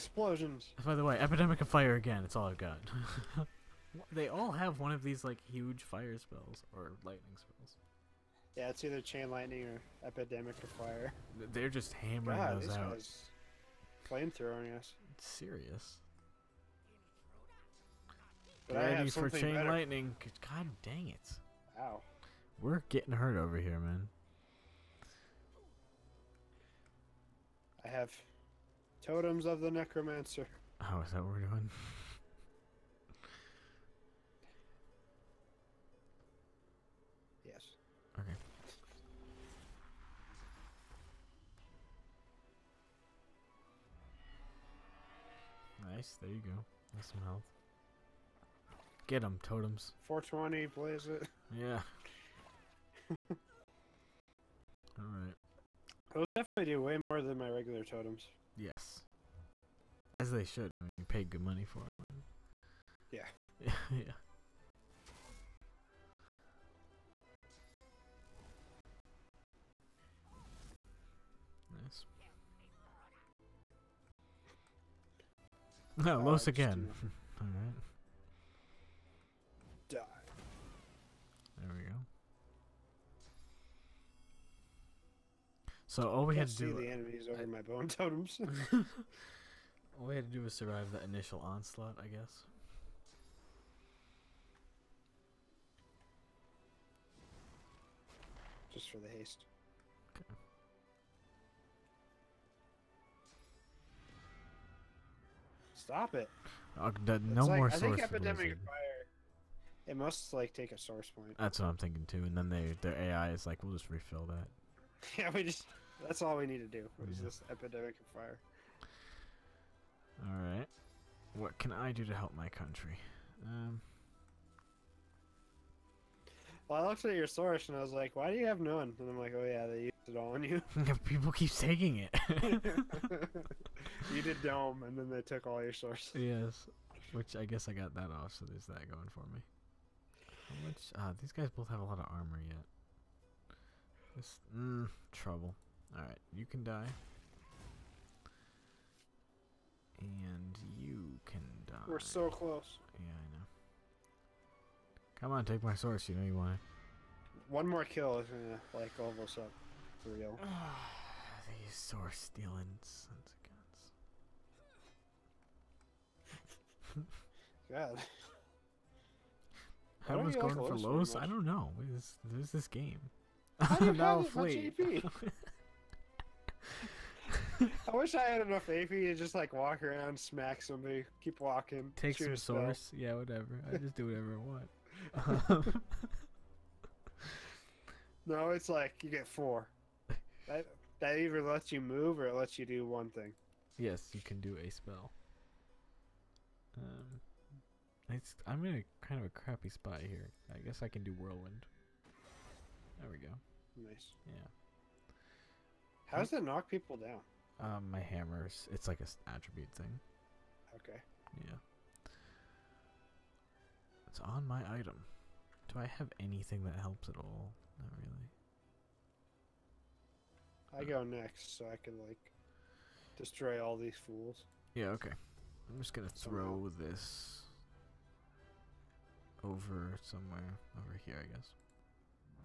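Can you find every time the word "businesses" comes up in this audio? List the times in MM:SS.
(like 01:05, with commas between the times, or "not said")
not said.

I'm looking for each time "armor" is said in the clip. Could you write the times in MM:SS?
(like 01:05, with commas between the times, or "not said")
02:22.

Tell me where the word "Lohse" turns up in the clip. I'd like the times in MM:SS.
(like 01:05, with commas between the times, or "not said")
01:16, 02:50.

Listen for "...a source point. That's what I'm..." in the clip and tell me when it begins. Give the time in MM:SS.
01:50.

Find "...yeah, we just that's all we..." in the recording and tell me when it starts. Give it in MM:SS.
01:55.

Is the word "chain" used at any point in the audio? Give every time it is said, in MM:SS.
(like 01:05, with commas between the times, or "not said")
00:09, 00:19.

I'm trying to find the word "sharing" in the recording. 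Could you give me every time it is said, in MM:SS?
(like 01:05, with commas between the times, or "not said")
not said.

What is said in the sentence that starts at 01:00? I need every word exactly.
I mean, you paid good money for them.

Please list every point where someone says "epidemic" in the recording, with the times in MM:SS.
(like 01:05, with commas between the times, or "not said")
00:01, 00:10, 01:48, 01:57.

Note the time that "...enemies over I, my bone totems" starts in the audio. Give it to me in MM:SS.
01:26.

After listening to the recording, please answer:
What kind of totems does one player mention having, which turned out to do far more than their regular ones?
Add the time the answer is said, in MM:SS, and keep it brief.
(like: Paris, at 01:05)
Totems of the necromancer, at 00:29.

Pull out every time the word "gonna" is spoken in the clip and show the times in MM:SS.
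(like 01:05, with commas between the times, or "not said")
02:38, 03:45.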